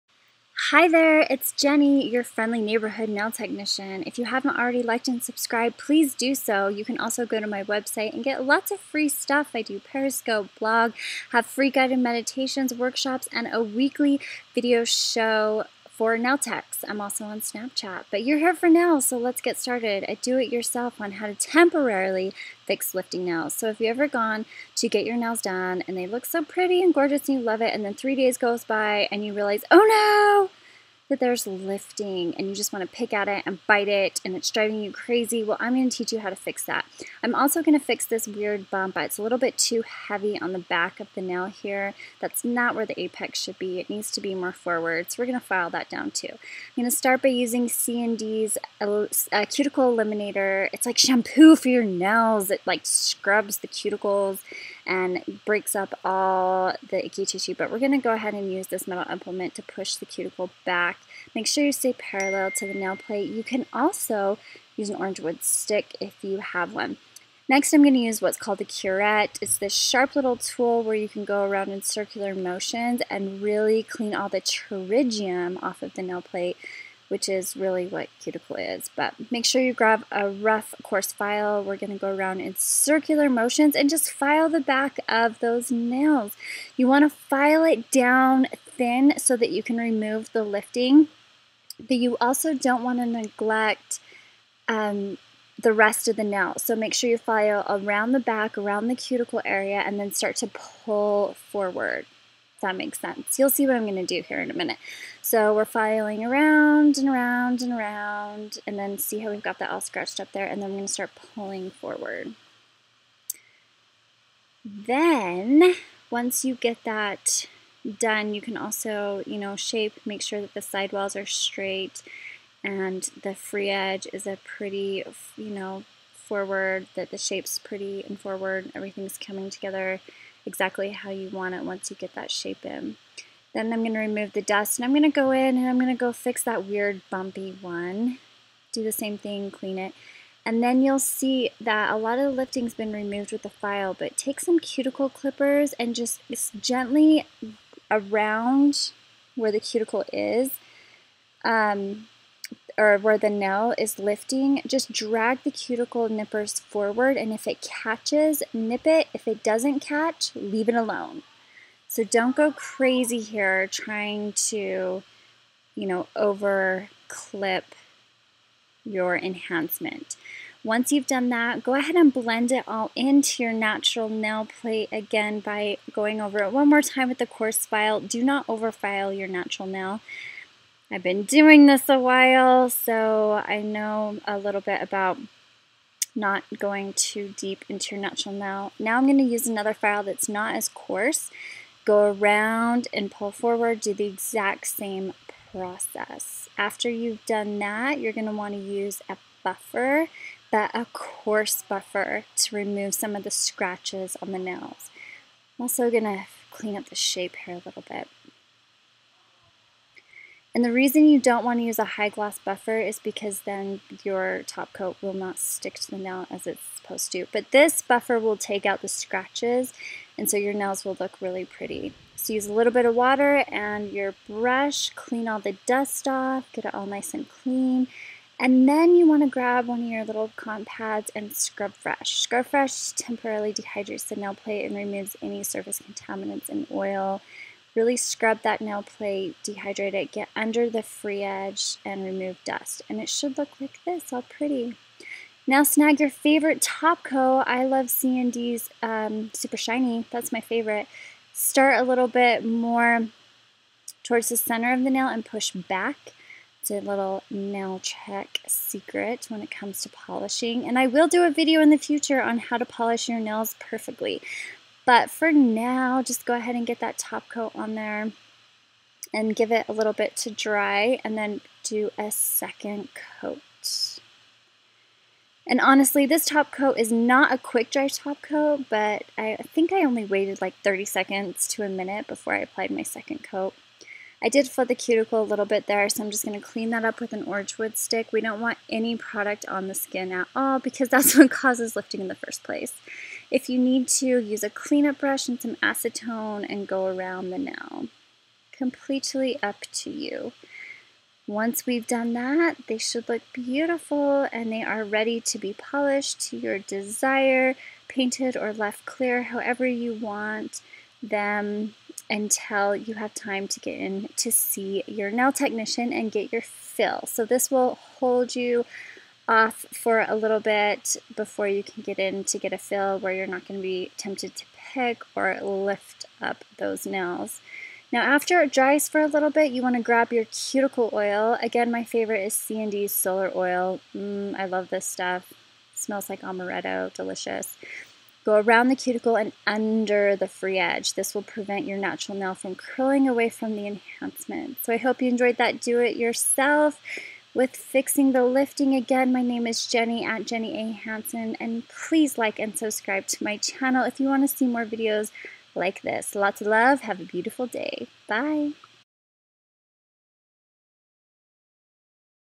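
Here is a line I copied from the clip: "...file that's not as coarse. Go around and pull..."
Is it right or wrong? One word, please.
right.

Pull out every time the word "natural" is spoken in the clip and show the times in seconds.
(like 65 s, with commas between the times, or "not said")
173 s, 179 s, 188 s, 341 s.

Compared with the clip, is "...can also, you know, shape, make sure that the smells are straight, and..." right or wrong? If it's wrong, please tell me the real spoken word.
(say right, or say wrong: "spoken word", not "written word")
wrong: "sidewalls", not "smells".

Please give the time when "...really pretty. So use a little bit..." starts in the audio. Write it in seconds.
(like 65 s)
221 s.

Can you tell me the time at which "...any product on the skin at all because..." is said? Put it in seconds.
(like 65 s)
288 s.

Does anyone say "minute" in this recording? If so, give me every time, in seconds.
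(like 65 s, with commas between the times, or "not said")
104 s, 281 s.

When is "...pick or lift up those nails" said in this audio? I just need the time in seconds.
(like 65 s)
324 s.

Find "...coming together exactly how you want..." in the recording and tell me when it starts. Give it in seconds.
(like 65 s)
129 s.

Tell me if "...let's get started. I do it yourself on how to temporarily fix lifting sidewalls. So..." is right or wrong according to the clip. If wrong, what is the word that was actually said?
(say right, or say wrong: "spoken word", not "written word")
wrong: "nails", not "sidewalls".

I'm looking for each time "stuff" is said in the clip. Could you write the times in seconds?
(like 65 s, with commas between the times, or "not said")
9 s, 334 s.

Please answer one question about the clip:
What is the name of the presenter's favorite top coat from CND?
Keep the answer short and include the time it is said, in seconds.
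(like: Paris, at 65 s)
Super Shiny, at 249 s.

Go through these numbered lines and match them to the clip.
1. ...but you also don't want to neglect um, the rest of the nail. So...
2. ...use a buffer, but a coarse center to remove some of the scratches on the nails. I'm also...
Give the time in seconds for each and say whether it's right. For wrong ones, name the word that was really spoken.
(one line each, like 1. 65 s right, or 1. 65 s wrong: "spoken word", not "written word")
1. 91 s right
2. 198 s wrong: "buffer", not "center".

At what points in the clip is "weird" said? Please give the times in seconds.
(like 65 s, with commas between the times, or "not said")
38 s, 136 s.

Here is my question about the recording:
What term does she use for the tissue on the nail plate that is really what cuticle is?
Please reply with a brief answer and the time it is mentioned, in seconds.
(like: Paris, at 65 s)
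pterygium, at 74 s.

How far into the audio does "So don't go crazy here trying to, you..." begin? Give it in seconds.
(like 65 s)
161 s.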